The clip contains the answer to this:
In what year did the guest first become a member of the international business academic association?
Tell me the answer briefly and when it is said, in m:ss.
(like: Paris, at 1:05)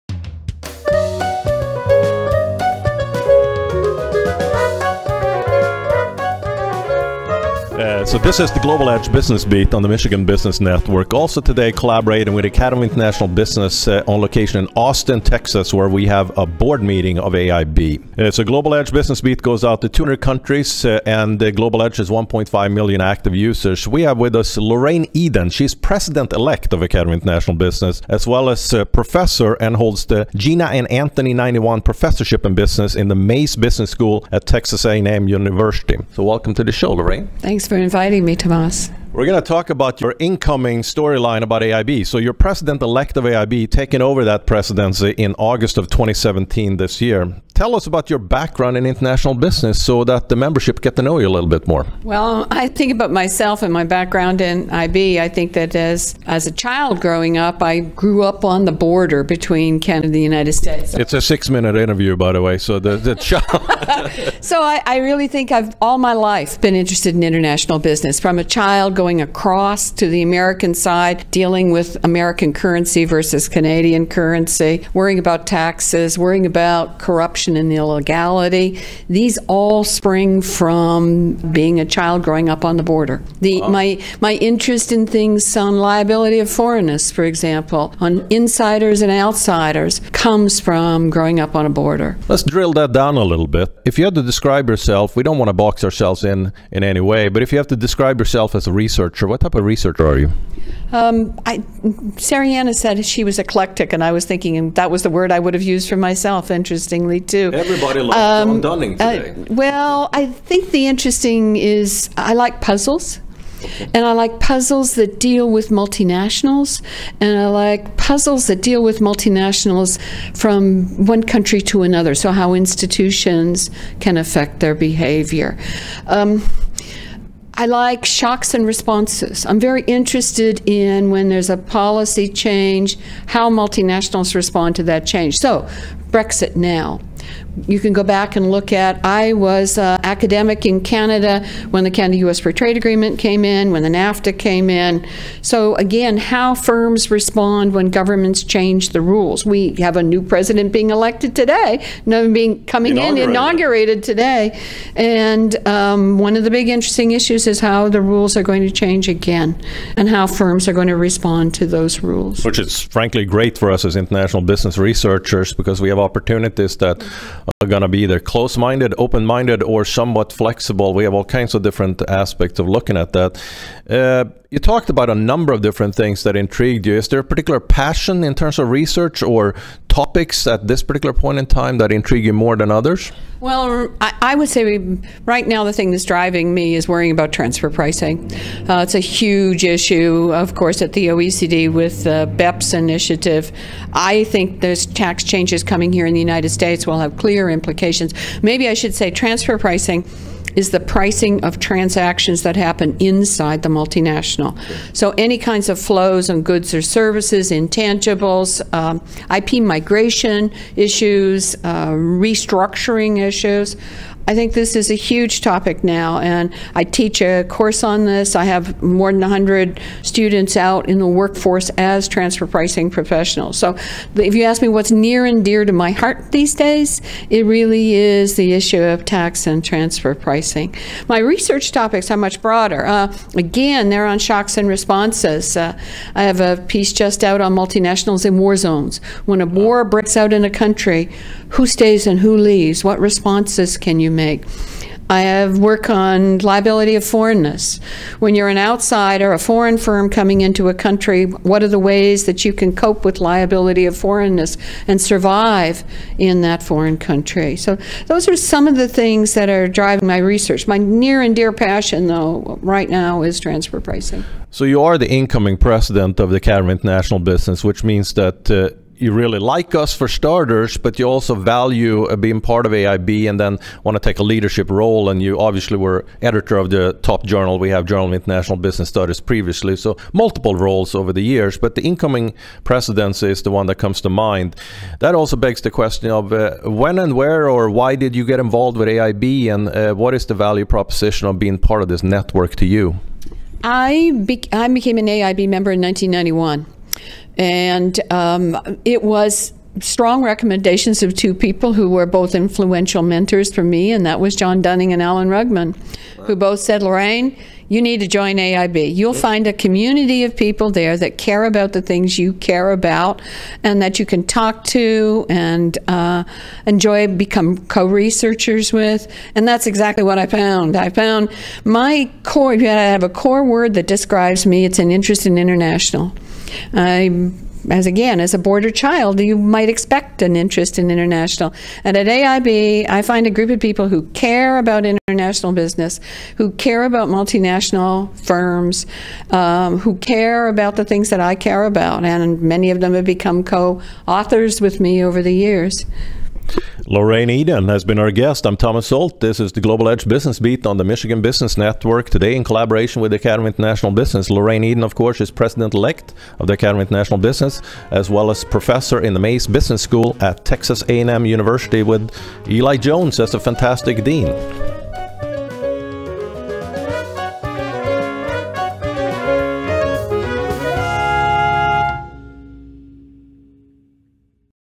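1991, at 4:55.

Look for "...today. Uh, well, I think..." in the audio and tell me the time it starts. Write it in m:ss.
1:49.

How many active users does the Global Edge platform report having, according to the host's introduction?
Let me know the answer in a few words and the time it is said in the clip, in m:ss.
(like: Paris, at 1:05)
1.5 million, at 0:22.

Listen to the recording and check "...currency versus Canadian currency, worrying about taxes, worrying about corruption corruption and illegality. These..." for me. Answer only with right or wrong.
right.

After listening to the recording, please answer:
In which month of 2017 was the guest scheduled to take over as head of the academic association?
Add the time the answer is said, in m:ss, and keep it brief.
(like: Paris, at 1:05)
August, at 0:45.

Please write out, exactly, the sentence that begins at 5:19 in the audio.
And that's exactly what I found.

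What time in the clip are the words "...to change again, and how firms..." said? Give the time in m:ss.
2:38.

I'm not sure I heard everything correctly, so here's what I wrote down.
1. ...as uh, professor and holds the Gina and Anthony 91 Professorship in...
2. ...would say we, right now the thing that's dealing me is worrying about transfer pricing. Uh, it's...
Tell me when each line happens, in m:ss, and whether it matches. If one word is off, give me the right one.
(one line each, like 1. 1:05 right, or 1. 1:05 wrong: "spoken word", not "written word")
1. 0:28 right
2. 3:04 wrong: "driving", not "dealing".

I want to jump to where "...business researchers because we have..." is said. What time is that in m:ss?
2:44.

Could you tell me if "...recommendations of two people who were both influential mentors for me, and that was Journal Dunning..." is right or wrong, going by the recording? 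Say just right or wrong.
wrong.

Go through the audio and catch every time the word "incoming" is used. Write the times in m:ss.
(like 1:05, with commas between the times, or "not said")
0:40, 4:25, 4:41.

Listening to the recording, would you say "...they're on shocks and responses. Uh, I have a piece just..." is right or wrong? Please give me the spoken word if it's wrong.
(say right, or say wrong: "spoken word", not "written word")
right.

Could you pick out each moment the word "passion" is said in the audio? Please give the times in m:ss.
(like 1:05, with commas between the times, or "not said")
2:57, 4:21.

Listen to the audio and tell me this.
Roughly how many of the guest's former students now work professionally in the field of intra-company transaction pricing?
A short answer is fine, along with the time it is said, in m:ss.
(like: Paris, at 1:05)
more than 100, at 3:38.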